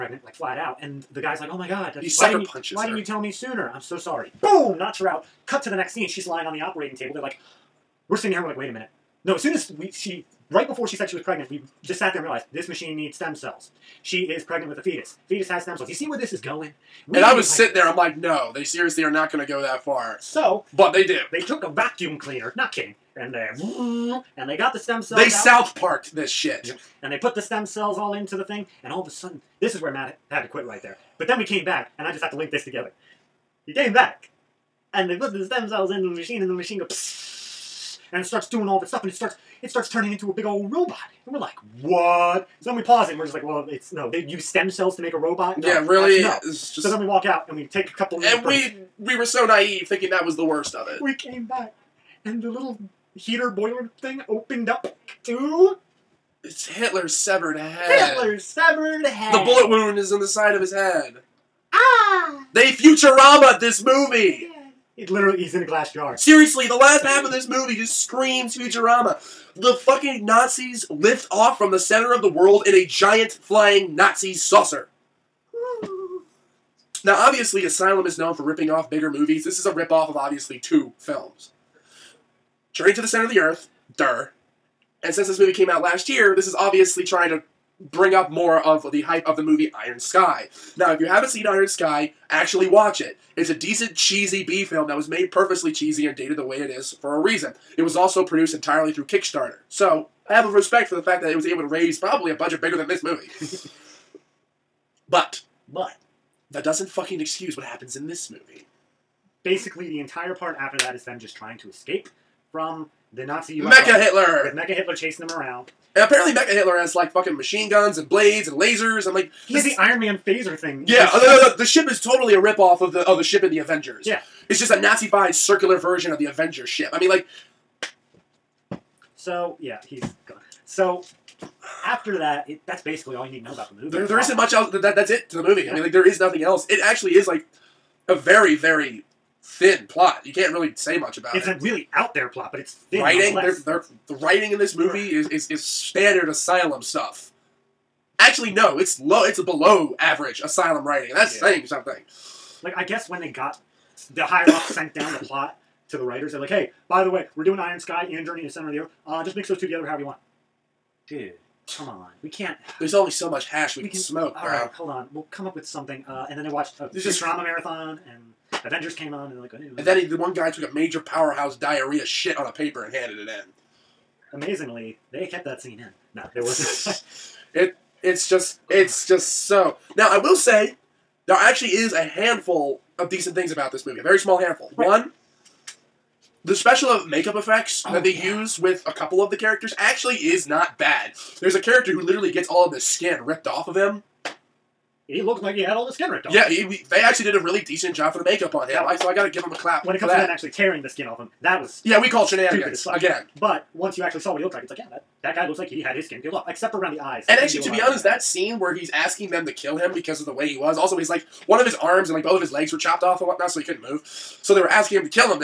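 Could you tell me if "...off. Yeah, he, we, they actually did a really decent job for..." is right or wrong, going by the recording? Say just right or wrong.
right.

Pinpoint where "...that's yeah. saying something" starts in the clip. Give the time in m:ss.
2:31.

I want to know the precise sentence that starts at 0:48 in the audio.
and we we were so naive, thinking that was the worst of it.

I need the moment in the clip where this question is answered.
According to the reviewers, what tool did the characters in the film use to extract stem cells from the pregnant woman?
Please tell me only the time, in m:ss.
0:21.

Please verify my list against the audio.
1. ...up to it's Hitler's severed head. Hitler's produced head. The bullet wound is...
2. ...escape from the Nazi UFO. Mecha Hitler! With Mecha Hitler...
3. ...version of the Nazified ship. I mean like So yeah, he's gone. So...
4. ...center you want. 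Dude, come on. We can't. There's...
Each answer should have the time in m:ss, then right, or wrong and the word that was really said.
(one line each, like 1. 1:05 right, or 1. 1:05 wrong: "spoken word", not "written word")
1. 0:54 wrong: "severed", not "produced"
2. 1:51 right
3. 2:05 wrong: "Avengers", not "Nazified"
4. 2:39 wrong: "however", not "center".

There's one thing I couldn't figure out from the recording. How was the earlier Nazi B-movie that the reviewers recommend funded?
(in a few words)
Kickstarter.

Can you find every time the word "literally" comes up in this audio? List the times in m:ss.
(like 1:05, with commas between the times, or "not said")
1:05, 3:11.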